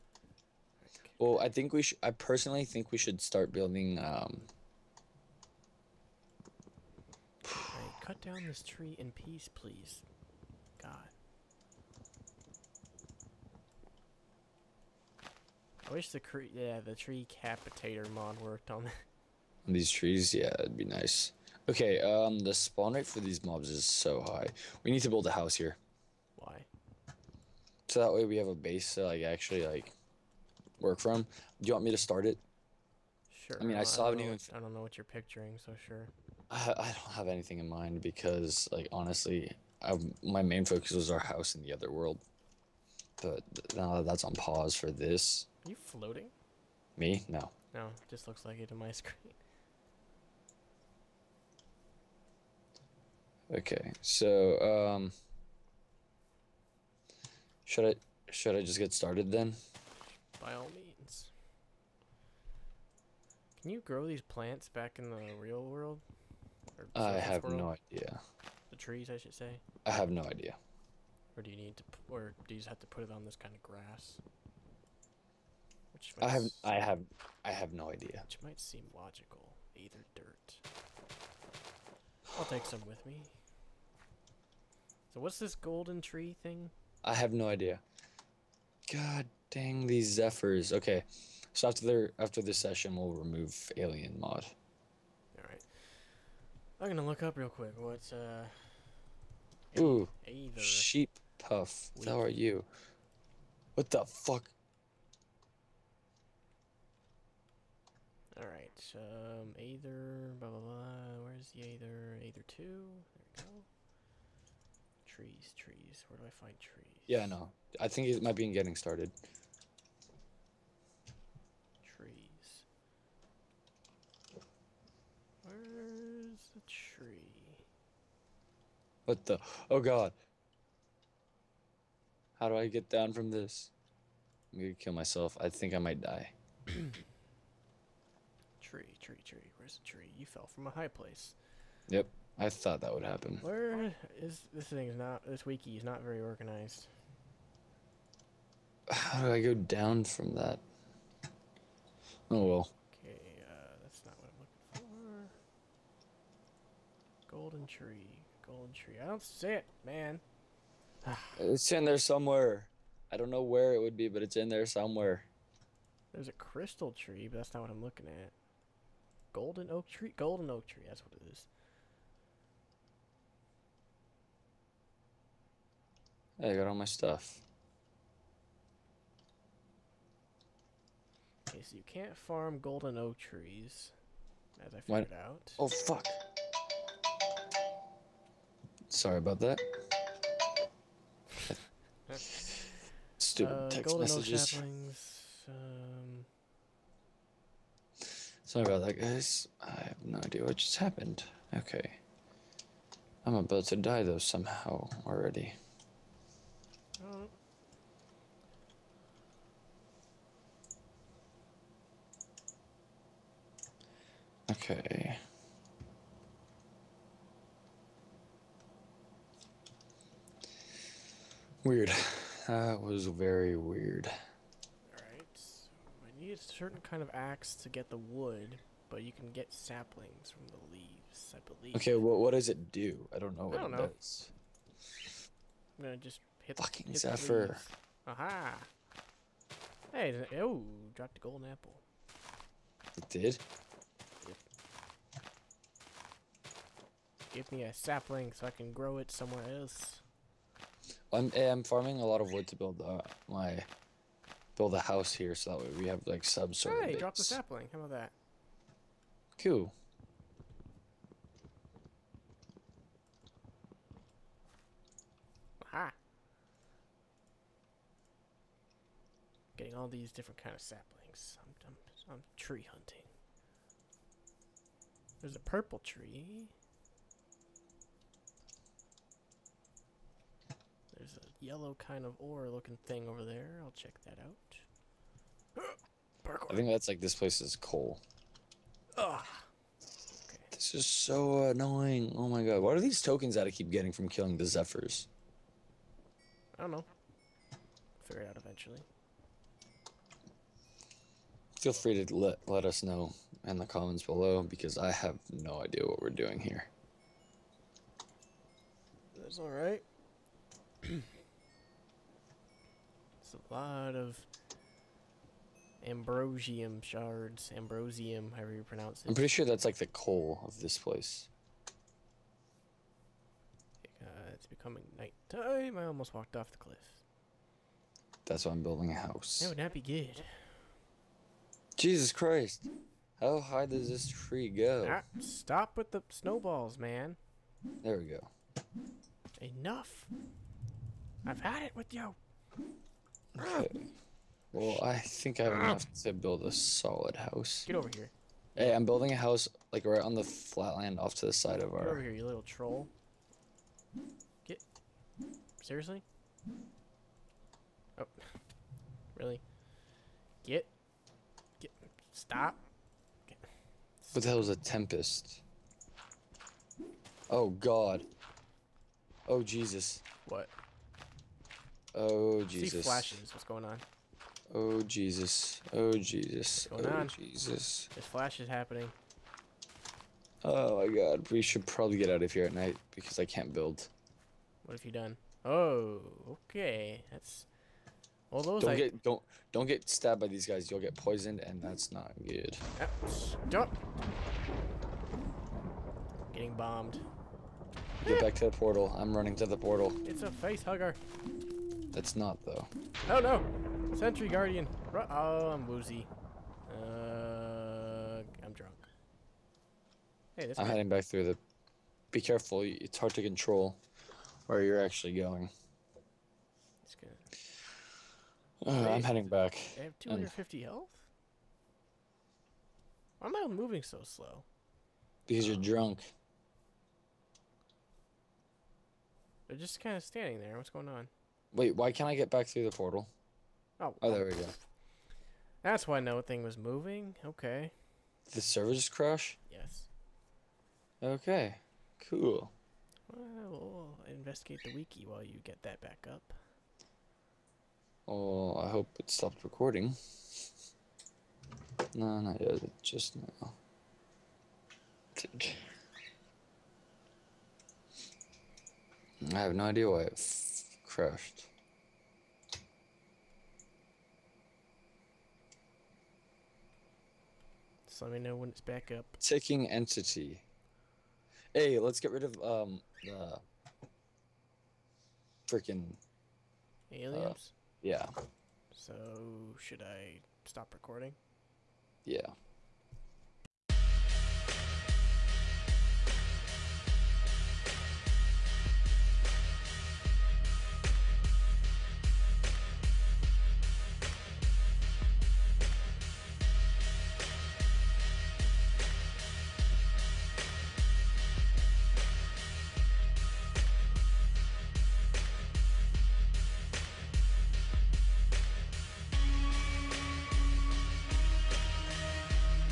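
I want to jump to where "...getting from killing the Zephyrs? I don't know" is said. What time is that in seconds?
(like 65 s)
293 s.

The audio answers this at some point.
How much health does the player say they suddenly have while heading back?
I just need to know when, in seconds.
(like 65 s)
419 s.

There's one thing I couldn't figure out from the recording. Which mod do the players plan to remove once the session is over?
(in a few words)
alien mod.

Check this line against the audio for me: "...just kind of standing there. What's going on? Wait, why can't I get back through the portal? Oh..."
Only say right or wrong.
right.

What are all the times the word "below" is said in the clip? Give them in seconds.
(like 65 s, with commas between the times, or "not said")
304 s.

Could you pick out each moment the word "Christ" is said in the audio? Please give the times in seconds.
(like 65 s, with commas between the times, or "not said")
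332 s.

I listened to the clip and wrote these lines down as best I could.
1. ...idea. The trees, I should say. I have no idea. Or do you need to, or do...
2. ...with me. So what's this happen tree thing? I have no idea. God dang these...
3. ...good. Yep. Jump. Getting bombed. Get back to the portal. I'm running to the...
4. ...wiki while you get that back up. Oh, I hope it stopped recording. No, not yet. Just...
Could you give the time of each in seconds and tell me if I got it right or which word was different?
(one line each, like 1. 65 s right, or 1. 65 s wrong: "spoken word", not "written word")
1. 67 s right
2. 82 s wrong: "golden", not "happen"
3. 392 s right
4. 444 s right.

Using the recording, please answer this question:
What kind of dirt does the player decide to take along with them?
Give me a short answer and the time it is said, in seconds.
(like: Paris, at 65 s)
Aether dirt, at 79 s.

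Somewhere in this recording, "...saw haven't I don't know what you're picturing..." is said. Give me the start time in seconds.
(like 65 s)
33 s.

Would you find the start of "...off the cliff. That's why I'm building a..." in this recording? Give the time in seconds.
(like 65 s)
326 s.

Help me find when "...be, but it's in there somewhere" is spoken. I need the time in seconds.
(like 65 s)
163 s.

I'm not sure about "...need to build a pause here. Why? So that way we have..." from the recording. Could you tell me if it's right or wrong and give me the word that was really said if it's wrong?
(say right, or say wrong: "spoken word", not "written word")
wrong: "house", not "pause".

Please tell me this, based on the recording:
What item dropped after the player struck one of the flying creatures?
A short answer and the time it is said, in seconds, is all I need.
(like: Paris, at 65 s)
golden apple, at 241 s.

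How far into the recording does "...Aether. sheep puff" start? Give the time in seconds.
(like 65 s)
100 s.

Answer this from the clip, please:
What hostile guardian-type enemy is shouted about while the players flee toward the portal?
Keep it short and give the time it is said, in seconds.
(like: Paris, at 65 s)
Sentry Guardian, at 403 s.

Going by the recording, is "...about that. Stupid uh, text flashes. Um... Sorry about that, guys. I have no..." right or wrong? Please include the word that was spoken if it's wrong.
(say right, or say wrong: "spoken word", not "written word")
wrong: "messages", not "flashes".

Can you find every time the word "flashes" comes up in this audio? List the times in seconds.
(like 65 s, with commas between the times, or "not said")
373 s, 378 s.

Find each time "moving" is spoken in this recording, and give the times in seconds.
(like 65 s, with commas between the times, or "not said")
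423 s, 436 s.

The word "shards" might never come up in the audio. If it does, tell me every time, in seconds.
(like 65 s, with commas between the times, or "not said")
316 s.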